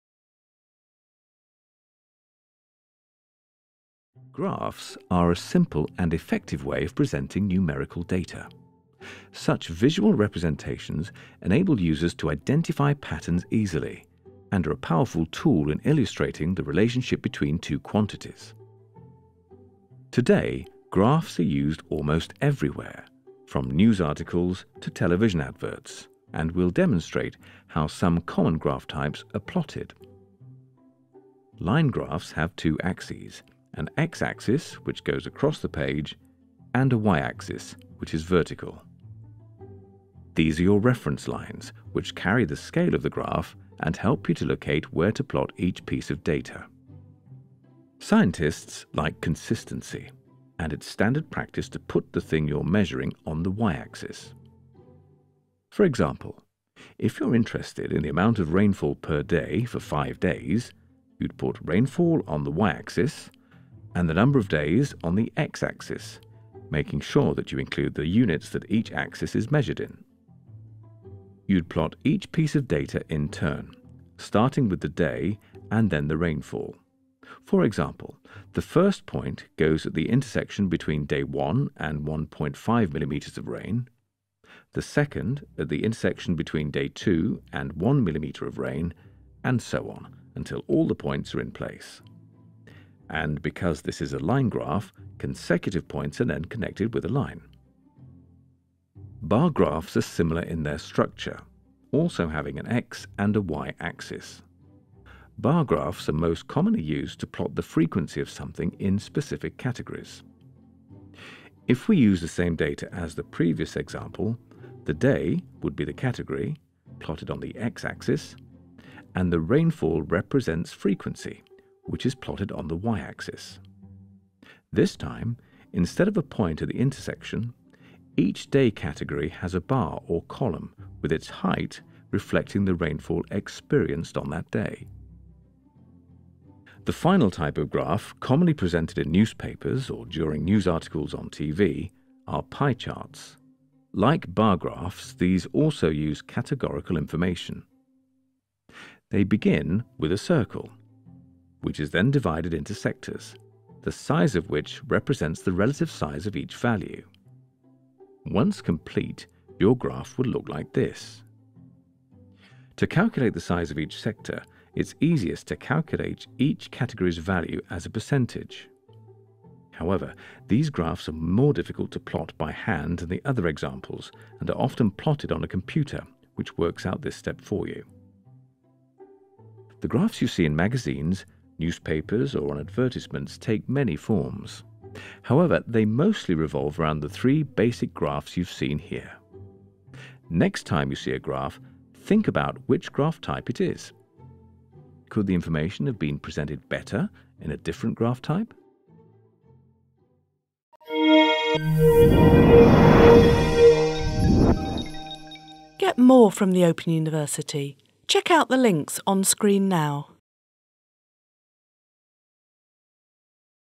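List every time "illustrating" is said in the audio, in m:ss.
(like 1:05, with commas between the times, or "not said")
0:15.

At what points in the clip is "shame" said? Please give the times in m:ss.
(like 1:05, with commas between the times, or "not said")
not said.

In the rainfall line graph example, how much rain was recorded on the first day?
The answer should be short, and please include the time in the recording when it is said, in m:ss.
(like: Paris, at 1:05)
1.5 millimeters, at 1:22.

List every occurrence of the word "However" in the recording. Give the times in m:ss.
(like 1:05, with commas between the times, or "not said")
2:49, 3:05.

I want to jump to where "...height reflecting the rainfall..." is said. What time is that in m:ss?
2:11.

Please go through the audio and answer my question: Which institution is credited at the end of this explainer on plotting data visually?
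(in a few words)
the Open University.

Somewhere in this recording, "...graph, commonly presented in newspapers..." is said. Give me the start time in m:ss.
2:17.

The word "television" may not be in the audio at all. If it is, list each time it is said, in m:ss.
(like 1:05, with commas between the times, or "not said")
0:24.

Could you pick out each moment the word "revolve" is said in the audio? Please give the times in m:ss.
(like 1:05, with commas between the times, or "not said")
3:06.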